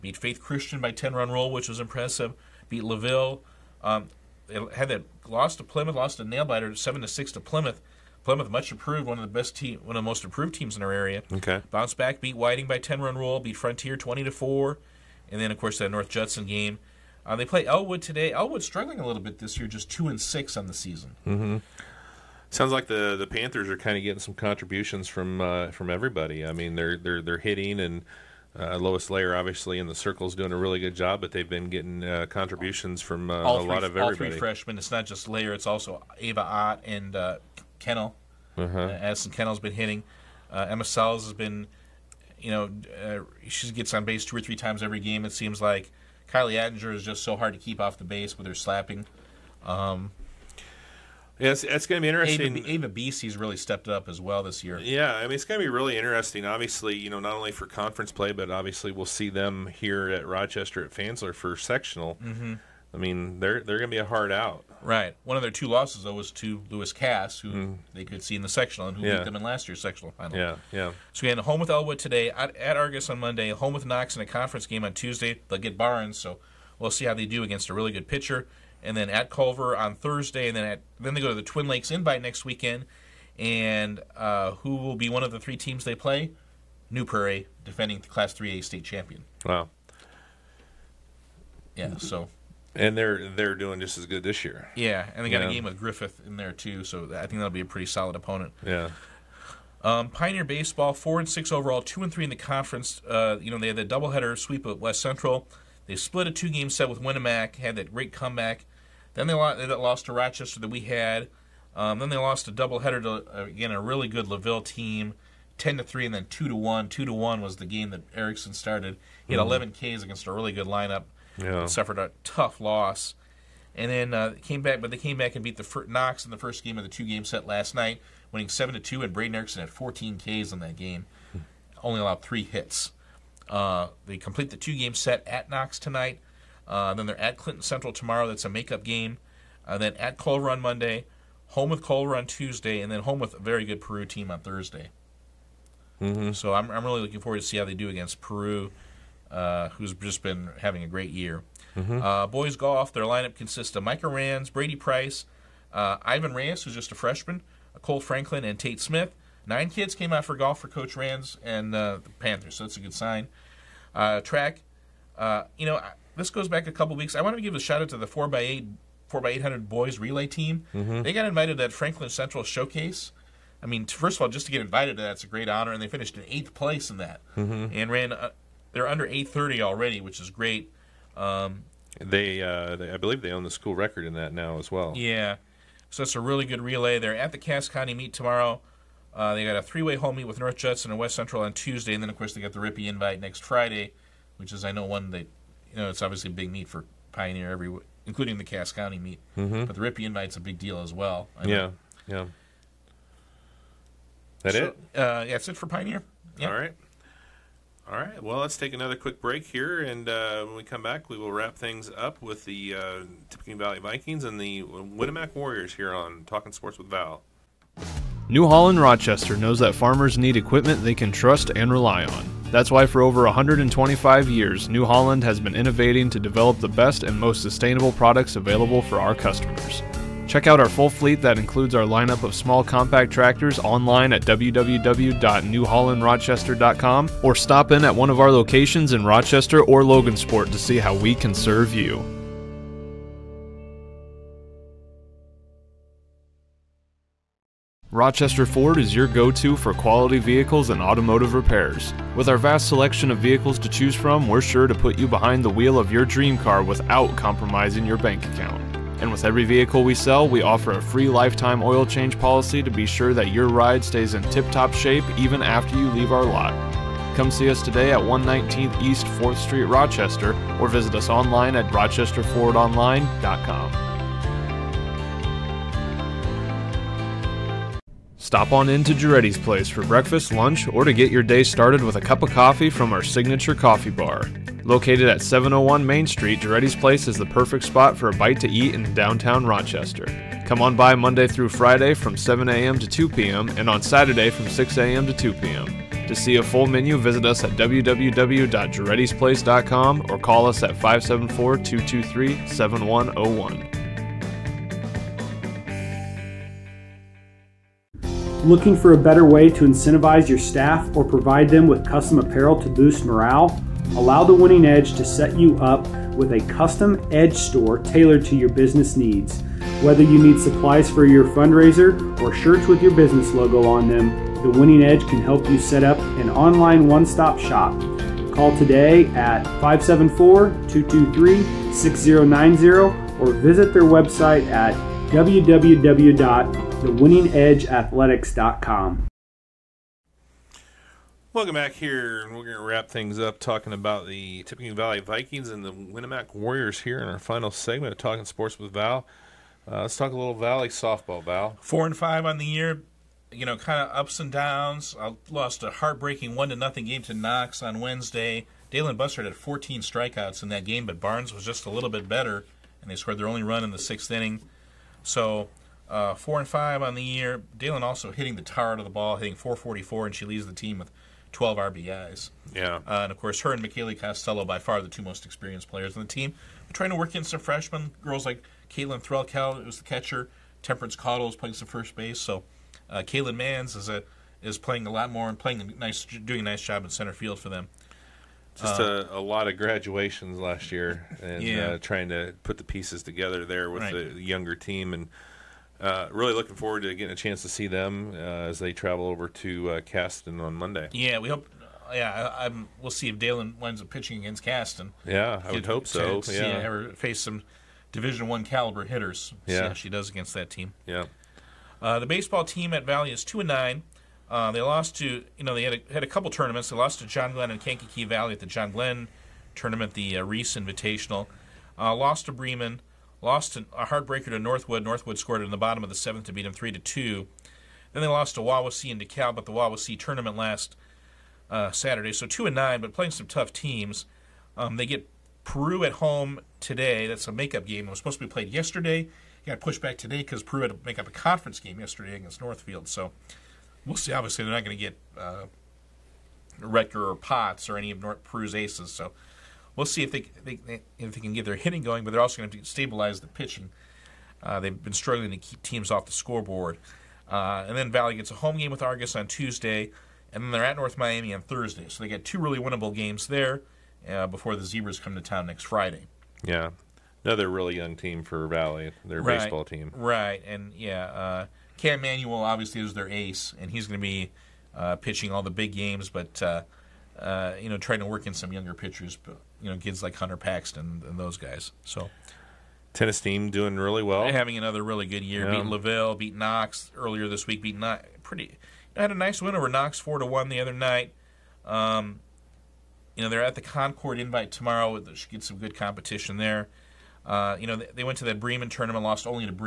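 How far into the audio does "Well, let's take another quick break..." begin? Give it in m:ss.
3:28.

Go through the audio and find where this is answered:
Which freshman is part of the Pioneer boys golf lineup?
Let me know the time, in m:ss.
2:36.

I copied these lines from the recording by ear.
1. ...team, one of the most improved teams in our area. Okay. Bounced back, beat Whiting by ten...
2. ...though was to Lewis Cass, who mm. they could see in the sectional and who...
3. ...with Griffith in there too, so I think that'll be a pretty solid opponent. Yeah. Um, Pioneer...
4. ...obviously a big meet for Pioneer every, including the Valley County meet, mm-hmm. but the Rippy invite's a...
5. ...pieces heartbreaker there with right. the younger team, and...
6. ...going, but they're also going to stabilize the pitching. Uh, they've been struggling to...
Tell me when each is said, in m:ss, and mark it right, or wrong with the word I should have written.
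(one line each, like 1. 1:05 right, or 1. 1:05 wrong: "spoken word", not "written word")
1. 0:09 right
2. 1:06 right
3. 1:35 right
4. 3:16 wrong: "Cass", not "Valley"
5. 6:32 wrong: "together", not "heartbreaker"
6. 7:31 right.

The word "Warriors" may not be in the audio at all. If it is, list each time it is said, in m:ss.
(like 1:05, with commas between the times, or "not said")
3:35, 5:46.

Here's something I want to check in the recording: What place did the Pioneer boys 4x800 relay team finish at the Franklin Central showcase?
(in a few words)
Eighth.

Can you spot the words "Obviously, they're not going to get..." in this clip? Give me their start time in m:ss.
7:24.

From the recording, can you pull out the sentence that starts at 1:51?
Um, then they lost a doubleheader to again a really good Laville team, ten to three, and then two to one.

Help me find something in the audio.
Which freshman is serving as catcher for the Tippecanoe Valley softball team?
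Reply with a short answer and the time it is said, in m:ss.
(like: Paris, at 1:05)
Caitlin Threlkel, at 6:18.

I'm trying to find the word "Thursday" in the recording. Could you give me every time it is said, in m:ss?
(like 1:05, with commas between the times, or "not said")
1:19, 2:24, 7:41.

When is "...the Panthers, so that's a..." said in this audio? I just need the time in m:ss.
2:42.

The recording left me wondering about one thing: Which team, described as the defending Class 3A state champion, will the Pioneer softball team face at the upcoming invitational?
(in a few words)
New Prairie.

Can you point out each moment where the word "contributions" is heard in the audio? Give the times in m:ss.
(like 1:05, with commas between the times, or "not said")
0:24, 0:32.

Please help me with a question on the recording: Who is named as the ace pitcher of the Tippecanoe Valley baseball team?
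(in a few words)
Cam Manuel.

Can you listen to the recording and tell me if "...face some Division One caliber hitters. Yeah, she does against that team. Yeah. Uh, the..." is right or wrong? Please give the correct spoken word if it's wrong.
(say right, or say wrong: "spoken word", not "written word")
right.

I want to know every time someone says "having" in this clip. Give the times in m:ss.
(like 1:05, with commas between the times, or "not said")
2:30, 8:04.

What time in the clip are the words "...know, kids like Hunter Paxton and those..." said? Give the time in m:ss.
7:59.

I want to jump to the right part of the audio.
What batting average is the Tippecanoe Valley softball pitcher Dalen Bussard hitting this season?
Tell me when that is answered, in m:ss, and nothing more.
6:09.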